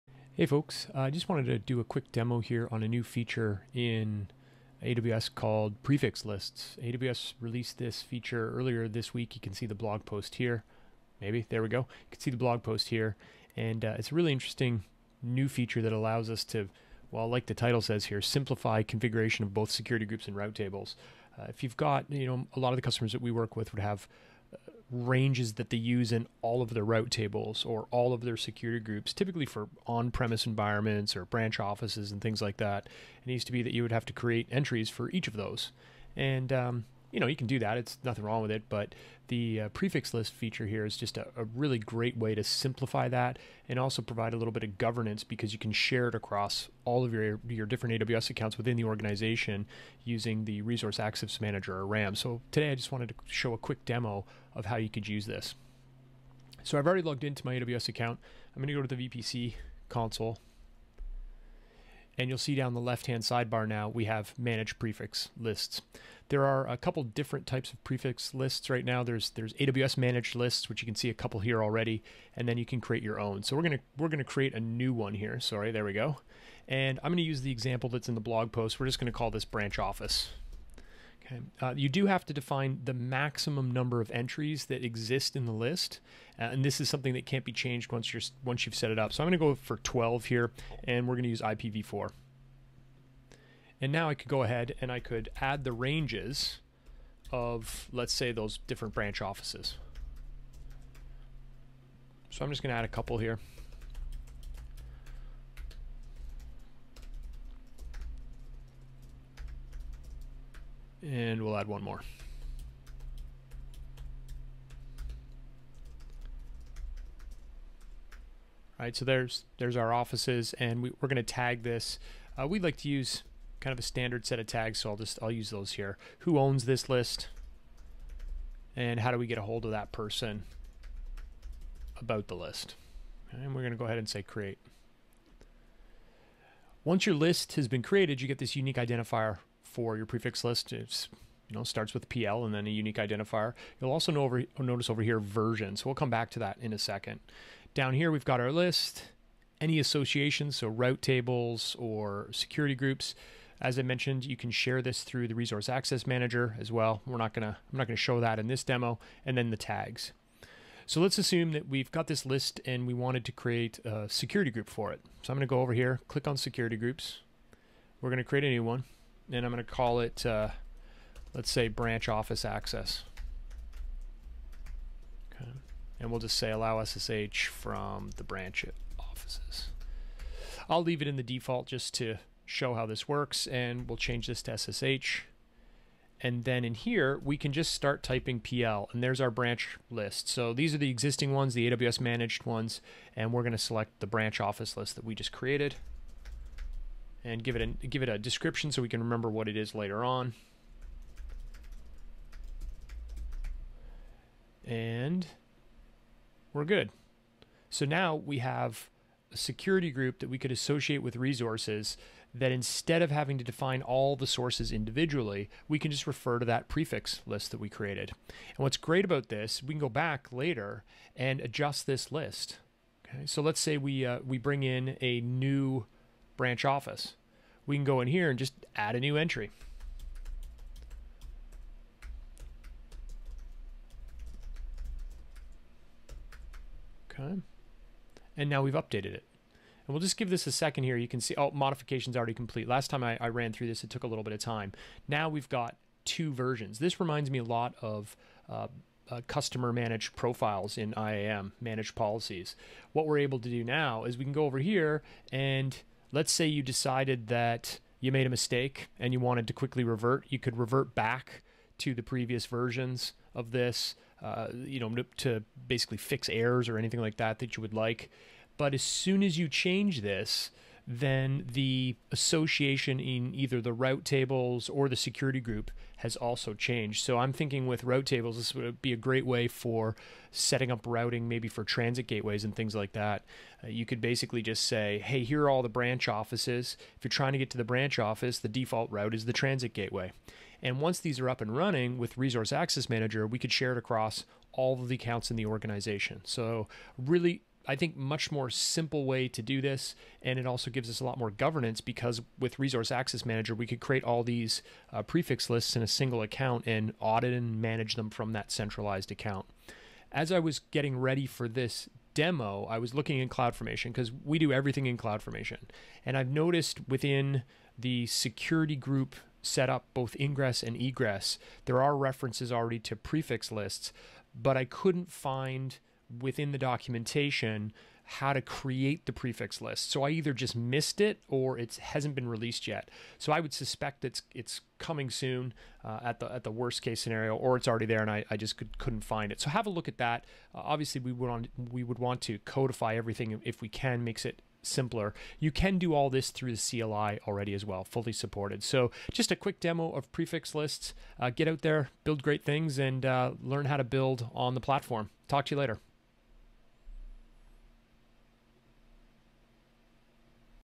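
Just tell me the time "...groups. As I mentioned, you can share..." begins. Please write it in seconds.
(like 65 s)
152 s.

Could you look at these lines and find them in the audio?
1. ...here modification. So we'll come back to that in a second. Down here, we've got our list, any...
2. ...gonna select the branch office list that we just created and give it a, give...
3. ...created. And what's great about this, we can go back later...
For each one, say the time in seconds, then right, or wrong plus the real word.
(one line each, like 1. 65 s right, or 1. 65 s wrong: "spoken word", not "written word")
1. 145 s wrong: "version", not "modification"
2. 193 s right
3. 217 s right.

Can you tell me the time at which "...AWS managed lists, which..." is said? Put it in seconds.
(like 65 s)
69 s.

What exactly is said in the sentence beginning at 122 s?
Uh, we'd like to use kind of a standard set of tags, so I'll just I'll use those here.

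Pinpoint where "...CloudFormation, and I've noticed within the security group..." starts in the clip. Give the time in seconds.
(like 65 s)
314 s.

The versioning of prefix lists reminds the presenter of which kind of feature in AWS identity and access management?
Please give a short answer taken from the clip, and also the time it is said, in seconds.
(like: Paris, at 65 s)
managed policies, at 251 s.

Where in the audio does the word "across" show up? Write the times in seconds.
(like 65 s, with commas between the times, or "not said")
46 s, 293 s.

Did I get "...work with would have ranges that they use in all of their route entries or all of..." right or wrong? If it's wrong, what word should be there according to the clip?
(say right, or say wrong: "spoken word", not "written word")
wrong: "tables", not "entries".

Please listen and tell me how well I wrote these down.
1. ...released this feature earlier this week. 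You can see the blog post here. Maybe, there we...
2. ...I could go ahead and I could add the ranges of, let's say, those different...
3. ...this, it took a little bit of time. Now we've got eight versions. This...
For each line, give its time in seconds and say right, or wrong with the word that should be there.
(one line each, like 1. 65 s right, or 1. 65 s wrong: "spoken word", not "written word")
1. 7 s right
2. 94 s right
3. 243 s wrong: "two", not "eight".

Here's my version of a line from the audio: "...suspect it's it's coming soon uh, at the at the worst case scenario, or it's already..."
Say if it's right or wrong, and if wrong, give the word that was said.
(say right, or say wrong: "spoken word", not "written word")
right.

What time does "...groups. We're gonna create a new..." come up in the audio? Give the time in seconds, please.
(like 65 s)
166 s.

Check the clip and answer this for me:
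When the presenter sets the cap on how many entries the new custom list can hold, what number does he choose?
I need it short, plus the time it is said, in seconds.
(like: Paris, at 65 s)
12, at 89 s.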